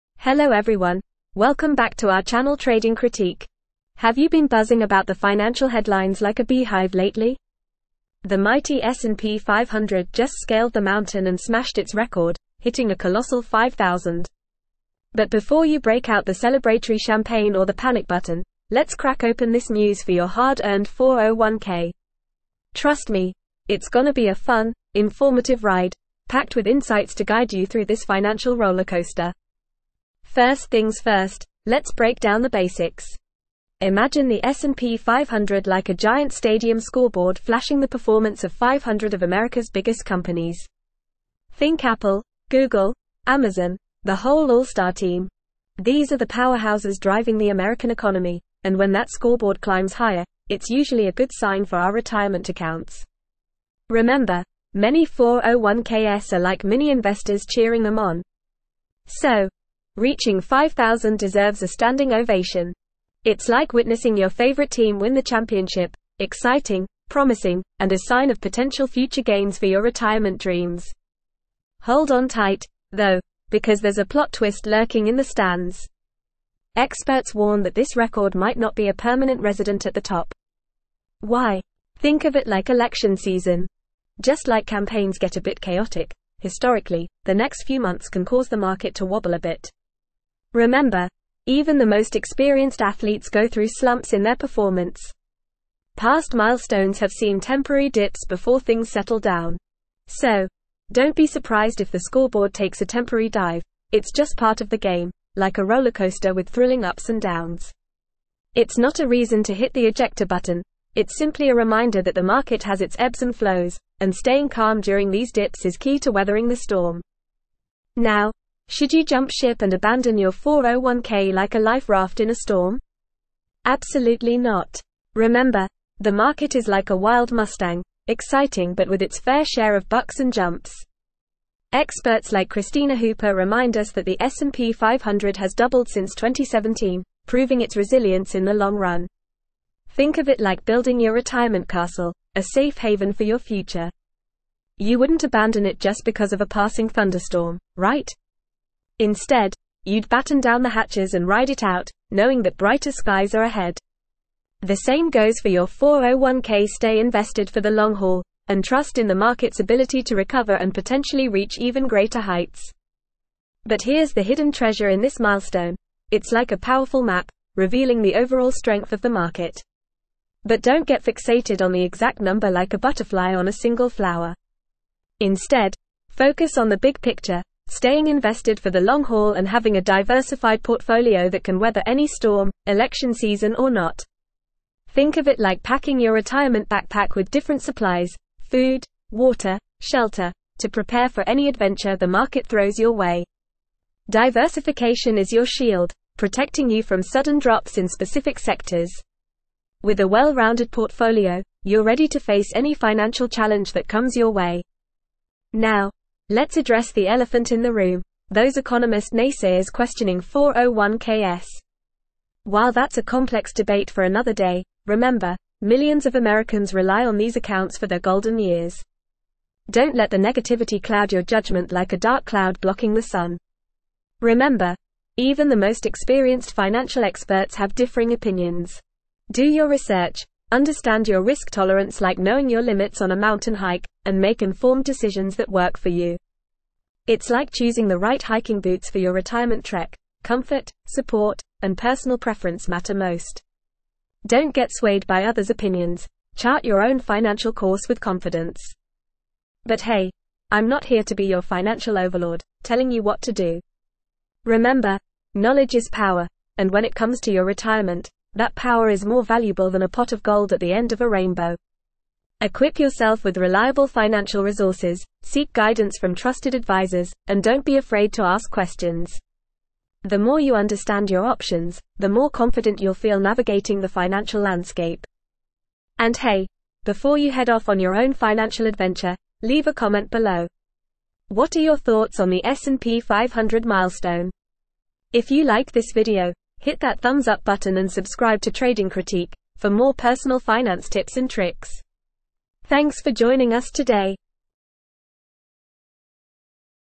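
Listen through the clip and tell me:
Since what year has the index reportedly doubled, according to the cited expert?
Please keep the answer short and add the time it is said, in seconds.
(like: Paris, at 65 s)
2017, at 136 s.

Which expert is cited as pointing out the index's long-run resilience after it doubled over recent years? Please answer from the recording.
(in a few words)
Kristina Hooper.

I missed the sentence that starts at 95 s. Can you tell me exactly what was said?
Past milestones have seen temporary dips before things settle down.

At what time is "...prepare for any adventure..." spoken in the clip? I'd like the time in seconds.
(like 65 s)
190 s.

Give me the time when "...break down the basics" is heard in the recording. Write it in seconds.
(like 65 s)
31 s.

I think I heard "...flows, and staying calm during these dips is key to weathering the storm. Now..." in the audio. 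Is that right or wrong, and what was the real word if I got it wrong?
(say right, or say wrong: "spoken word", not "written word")
right.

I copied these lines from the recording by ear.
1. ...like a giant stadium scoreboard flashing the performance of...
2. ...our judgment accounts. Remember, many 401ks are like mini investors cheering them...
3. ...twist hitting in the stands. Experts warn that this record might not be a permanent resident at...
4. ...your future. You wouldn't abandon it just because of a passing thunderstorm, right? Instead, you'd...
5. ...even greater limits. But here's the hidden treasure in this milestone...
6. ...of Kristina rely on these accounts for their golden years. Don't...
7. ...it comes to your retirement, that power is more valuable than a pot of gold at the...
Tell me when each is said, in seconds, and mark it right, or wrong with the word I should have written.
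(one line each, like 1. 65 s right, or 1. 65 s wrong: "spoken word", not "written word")
1. 35 s right
2. 51 s wrong: "retirement", not "judgment"
3. 74 s wrong: "lurking", not "hitting"
4. 143 s right
5. 161 s wrong: "heights", not "limits"
6. 216 s wrong: "Americans", not "Kristina"
7. 256 s right.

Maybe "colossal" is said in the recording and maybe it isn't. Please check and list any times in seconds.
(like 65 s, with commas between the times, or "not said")
12 s.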